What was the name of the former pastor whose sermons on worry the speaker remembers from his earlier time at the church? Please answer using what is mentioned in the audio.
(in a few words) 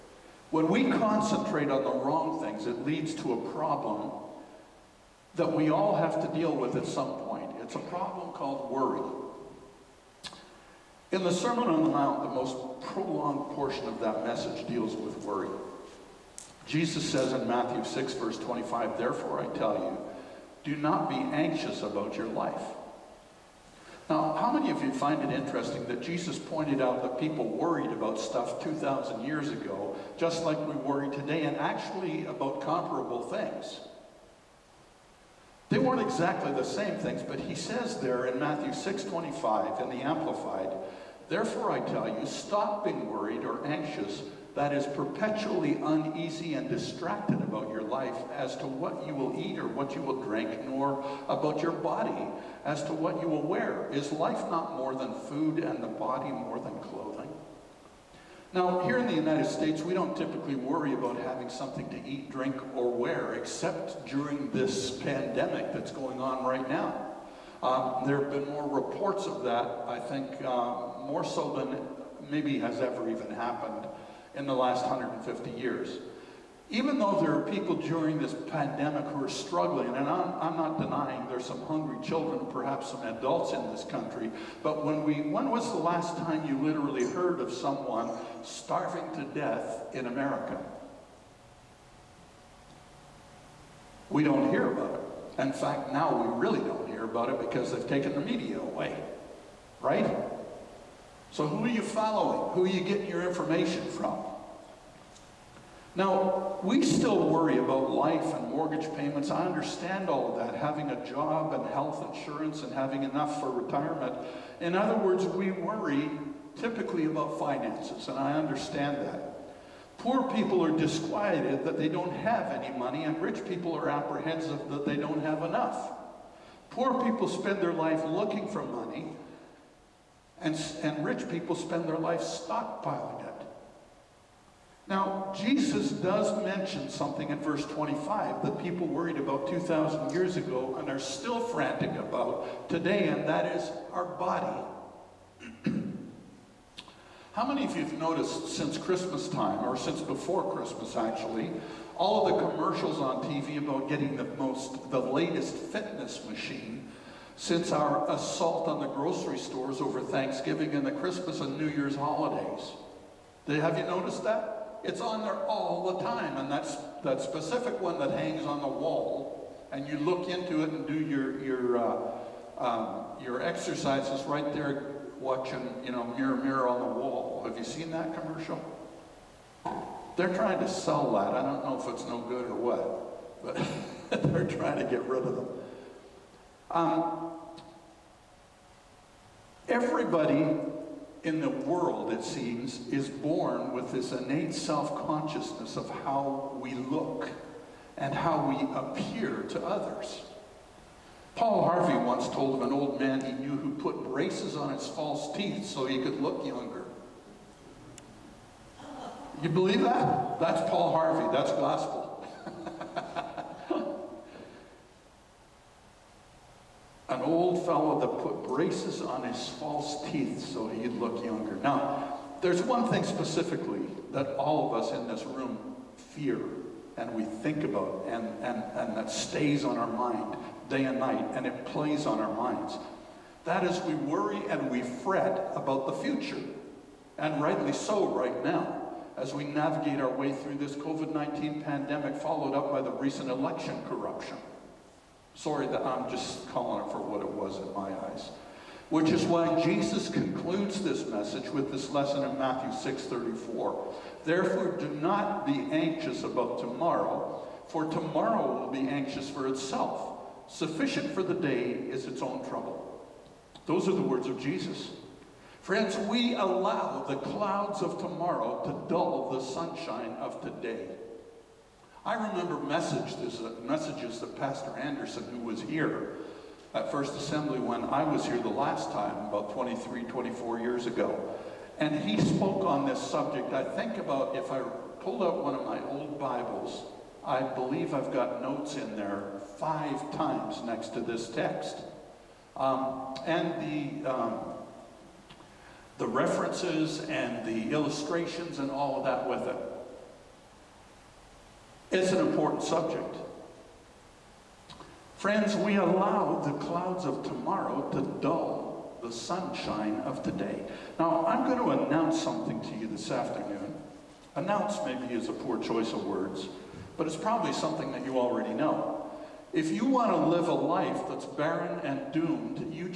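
Pastor Anderson.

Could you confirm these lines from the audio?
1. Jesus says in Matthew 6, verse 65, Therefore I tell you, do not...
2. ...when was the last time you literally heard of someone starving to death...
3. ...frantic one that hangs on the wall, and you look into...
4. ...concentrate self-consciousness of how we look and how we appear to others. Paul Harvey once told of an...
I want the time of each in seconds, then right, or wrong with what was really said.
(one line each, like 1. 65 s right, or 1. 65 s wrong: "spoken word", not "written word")
1. 16 s wrong: "25", not "65"
2. 85 s right
3. 167 s wrong: "specific", not "frantic"
4. 194 s wrong: "innate", not "concentrate".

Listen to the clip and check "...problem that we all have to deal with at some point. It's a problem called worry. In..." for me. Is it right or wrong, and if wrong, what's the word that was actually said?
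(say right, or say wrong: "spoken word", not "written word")
right.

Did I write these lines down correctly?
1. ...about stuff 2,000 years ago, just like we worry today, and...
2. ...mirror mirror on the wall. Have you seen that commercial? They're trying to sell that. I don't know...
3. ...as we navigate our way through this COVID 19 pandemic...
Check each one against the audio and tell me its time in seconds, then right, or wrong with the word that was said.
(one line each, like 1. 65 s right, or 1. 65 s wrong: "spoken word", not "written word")
1. 27 s right
2. 176 s right
3. 239 s right.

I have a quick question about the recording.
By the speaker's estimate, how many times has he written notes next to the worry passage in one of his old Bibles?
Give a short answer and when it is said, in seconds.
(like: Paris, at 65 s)
5, at 289 s.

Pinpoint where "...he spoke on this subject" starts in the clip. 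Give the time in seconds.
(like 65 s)
281 s.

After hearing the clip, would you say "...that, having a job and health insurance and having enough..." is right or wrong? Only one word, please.
right.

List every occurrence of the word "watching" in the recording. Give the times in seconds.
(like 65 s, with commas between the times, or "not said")
175 s.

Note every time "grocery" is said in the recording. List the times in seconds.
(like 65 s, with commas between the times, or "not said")
158 s.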